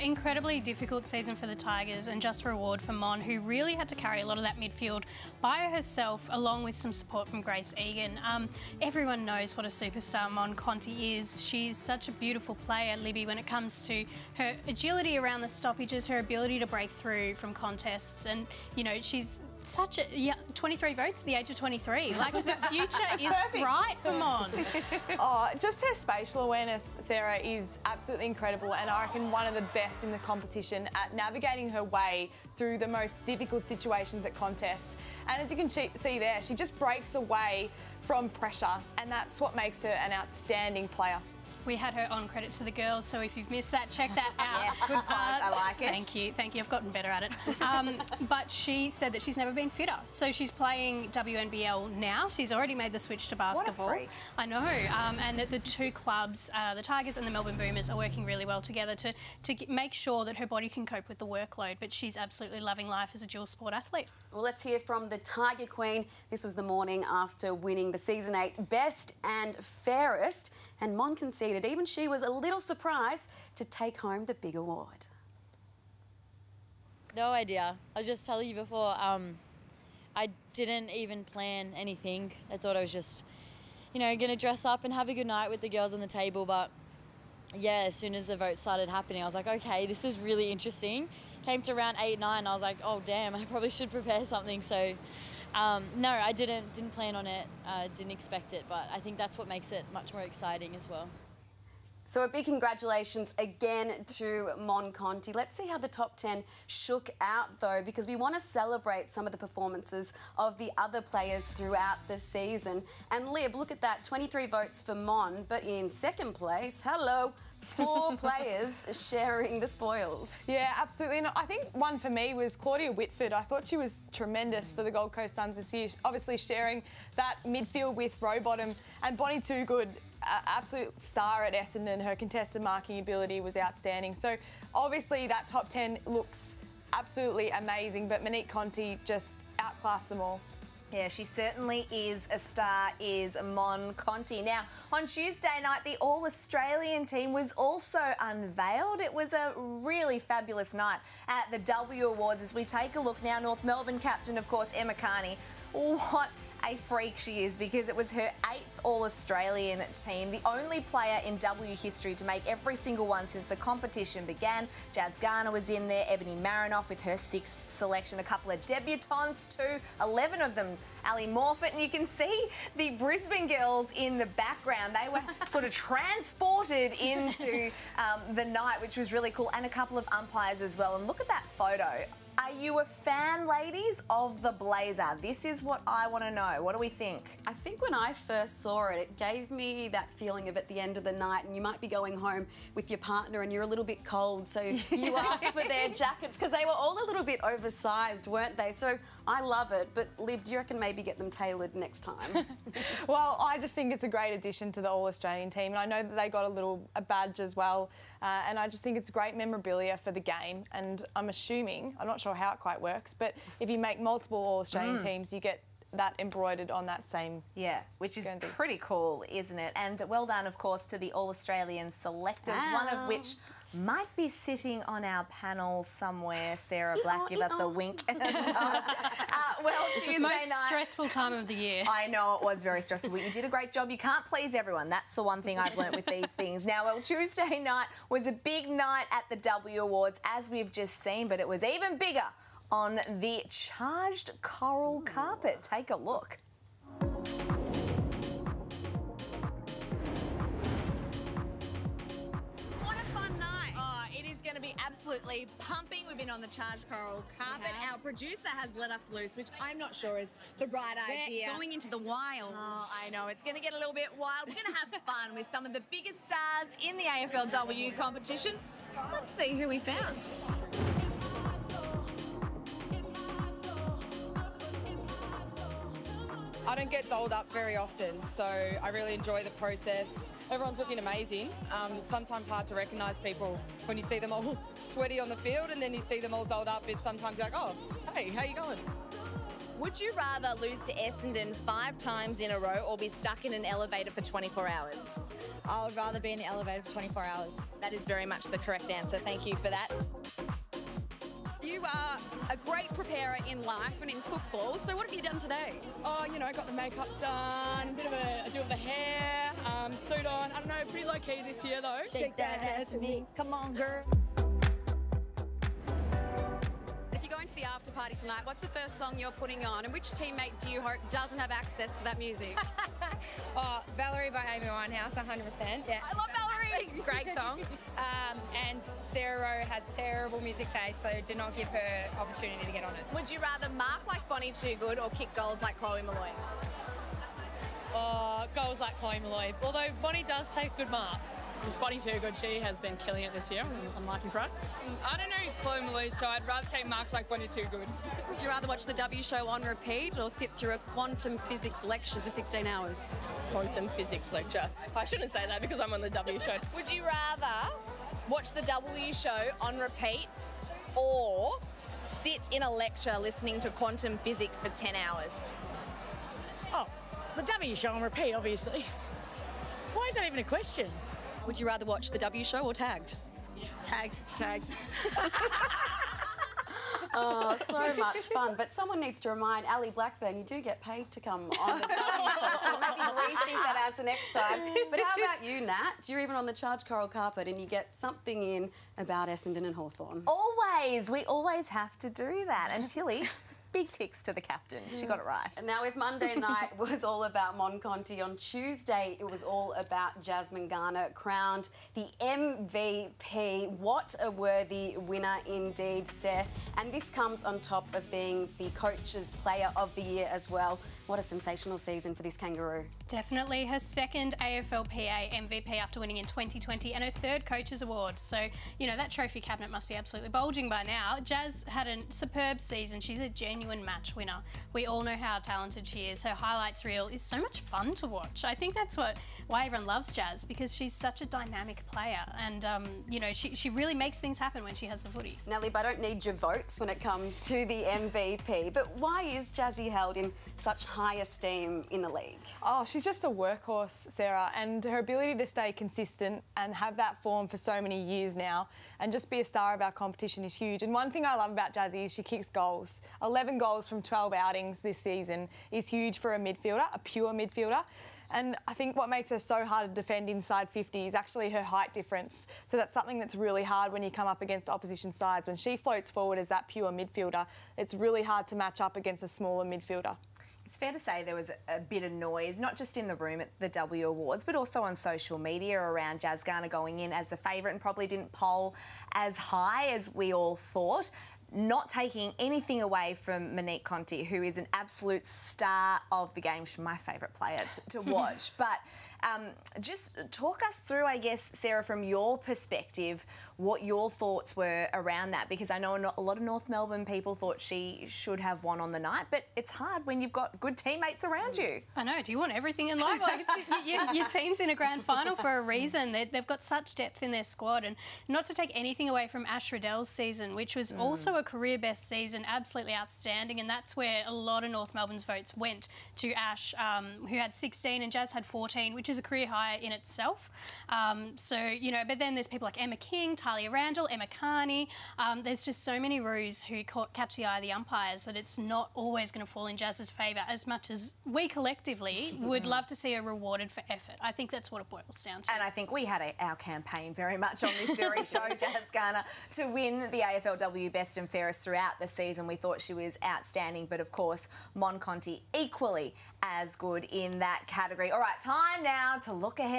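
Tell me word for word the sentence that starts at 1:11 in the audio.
Even she was a little surprised to take home the big award.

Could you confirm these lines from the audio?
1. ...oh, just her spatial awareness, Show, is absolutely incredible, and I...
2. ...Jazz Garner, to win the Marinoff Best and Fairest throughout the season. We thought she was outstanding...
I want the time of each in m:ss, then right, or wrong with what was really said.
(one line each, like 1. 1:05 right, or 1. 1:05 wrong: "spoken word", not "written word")
1. 0:25 wrong: "Sarah", not "Show"
2. 8:58 wrong: "AFLW", not "Marinoff".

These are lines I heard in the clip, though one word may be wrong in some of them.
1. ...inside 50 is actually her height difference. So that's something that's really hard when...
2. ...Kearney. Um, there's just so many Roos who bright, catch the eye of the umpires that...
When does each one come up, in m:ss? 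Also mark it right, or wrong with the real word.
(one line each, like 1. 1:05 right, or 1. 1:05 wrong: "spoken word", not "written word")
1. 7:40 right
2. 8:44 wrong: "caught", not "bright".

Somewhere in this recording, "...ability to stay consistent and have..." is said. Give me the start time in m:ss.
7:24.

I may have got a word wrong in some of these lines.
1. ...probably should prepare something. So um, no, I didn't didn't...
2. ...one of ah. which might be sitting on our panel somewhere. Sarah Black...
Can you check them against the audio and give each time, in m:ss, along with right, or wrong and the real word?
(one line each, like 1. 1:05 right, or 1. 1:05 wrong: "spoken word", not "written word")
1. 1:33 right
2. 3:42 right.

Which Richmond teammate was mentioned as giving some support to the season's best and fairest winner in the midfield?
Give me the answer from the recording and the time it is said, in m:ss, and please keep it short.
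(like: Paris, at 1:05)
Grace Egan, at 0:07.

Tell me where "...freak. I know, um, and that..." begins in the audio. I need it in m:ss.
0:53.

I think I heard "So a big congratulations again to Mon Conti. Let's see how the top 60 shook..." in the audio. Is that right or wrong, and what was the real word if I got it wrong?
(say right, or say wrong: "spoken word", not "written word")
wrong: "10", not "60".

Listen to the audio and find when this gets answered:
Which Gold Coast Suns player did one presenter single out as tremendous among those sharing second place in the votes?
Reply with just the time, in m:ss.
2:02.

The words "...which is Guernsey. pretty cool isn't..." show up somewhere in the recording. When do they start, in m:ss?
3:37.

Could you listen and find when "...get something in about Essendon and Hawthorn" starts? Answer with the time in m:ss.
6:27.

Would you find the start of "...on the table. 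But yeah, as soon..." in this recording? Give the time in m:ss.
1:25.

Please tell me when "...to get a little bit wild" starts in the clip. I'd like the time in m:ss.
4:23.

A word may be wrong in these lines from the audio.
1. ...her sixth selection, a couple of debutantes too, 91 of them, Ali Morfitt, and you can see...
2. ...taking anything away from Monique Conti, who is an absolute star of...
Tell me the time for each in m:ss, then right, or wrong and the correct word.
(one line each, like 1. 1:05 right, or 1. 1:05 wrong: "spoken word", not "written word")
1. 2:47 wrong: "11", not "91"
2. 8:01 right.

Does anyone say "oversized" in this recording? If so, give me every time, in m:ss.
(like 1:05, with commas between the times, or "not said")
3:17.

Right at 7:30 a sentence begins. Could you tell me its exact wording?
And one thing I love about Jazzy is she kicks goals.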